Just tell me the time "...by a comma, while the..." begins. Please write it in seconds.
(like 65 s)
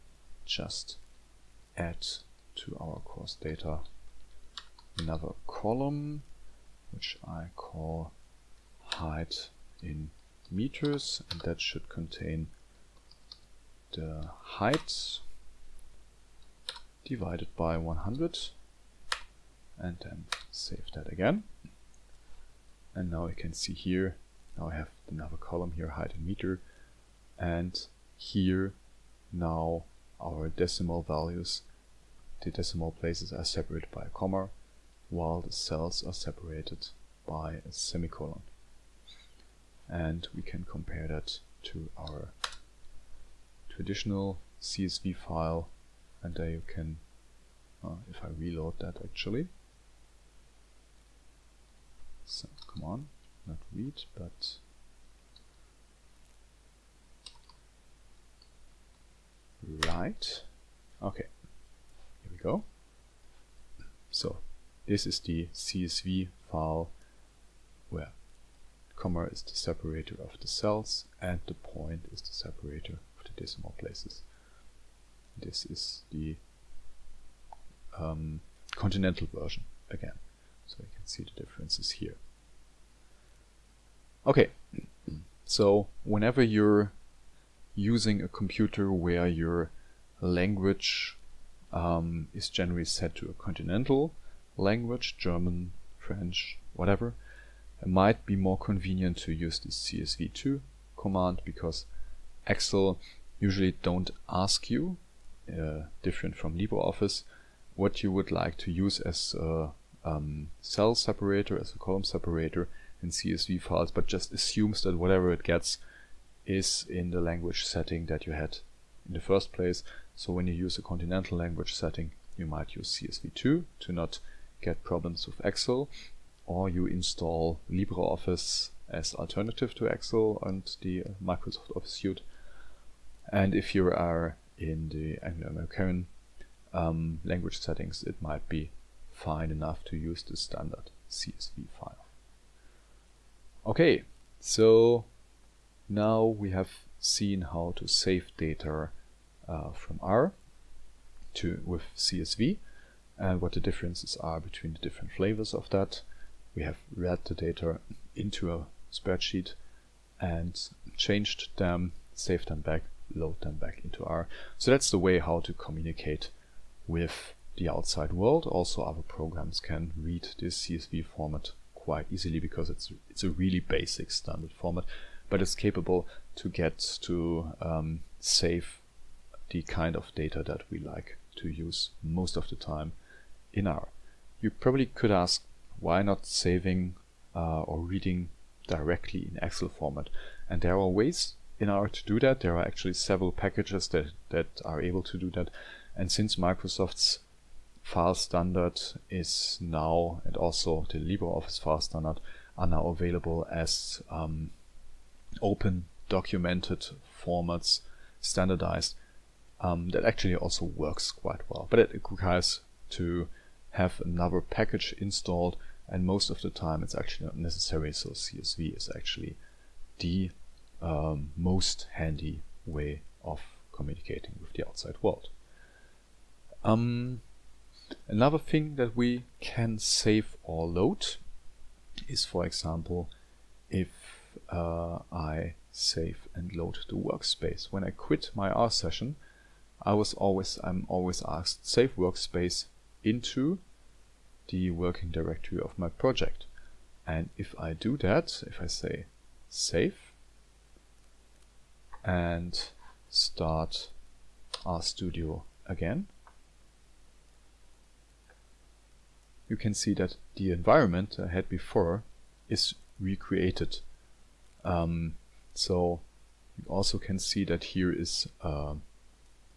33 s.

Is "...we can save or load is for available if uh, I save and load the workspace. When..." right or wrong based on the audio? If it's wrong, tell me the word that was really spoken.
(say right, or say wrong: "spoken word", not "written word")
wrong: "example", not "available".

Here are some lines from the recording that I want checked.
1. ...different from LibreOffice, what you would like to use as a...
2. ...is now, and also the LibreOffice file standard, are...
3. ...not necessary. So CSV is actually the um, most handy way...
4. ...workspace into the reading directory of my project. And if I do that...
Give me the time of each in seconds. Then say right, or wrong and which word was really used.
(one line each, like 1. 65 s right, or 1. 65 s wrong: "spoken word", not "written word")
1. 106 s right
2. 199 s right
3. 217 s right
4. 241 s wrong: "working", not "reading".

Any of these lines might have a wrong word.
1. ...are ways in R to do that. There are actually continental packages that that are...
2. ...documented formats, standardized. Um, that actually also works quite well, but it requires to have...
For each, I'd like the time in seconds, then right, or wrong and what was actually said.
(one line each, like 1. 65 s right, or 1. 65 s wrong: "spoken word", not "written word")
1. 190 s wrong: "several", not "continental"
2. 206 s right.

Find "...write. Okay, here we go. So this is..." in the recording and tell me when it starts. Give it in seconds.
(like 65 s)
59 s.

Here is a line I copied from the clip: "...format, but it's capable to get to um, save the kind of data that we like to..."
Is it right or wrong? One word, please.
right.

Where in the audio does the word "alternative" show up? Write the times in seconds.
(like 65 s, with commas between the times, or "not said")
129 s.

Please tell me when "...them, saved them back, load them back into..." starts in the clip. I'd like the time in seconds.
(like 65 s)
161 s.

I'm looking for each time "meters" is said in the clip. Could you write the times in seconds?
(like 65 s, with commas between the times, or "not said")
10 s, 26 s.